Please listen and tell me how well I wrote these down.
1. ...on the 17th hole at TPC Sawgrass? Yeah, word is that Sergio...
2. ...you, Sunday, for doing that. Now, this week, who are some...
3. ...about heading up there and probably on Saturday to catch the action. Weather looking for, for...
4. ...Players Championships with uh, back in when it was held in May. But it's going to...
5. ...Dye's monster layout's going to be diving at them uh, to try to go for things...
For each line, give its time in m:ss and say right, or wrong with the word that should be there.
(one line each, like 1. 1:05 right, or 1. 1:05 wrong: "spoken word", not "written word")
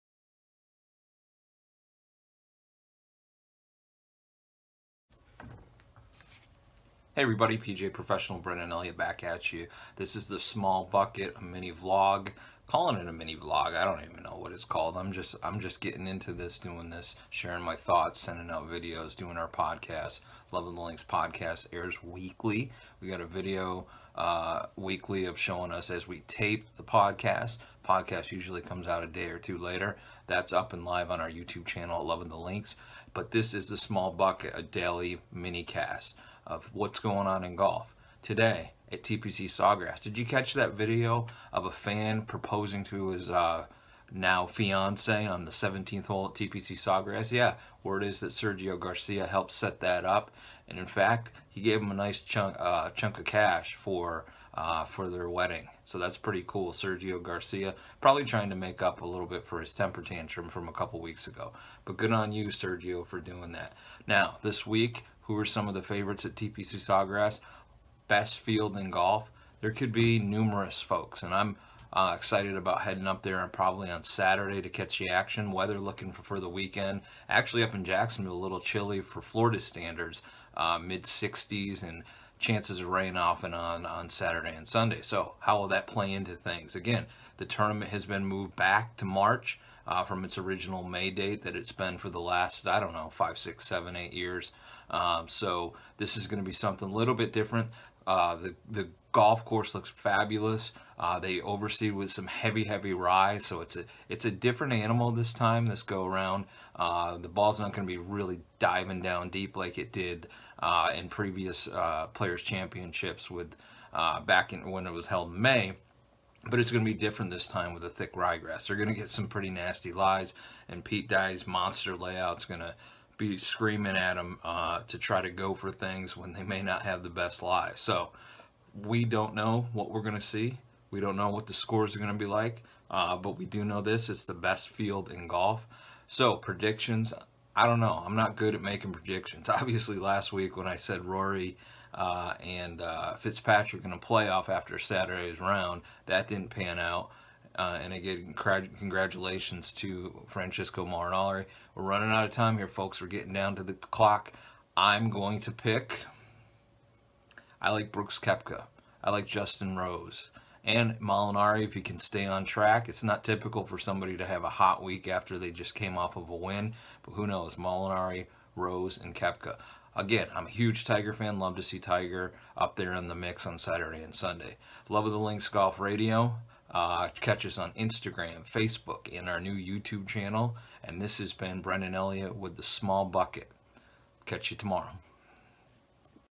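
1. 0:45 right
2. 1:02 wrong: "Sergio", not "Sunday"
3. 1:12 right
4. 1:52 right
5. 2:01 wrong: "screaming", not "diving".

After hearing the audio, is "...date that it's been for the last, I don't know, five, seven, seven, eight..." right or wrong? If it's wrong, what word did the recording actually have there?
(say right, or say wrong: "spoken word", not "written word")
wrong: "six", not "seven".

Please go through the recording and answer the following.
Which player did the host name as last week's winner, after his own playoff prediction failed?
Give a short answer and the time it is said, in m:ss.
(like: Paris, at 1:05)
Francesco Molinari, at 2:30.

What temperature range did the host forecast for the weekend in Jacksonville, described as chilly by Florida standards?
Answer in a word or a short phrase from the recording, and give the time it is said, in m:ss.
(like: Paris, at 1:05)
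mid 60s, at 1:20.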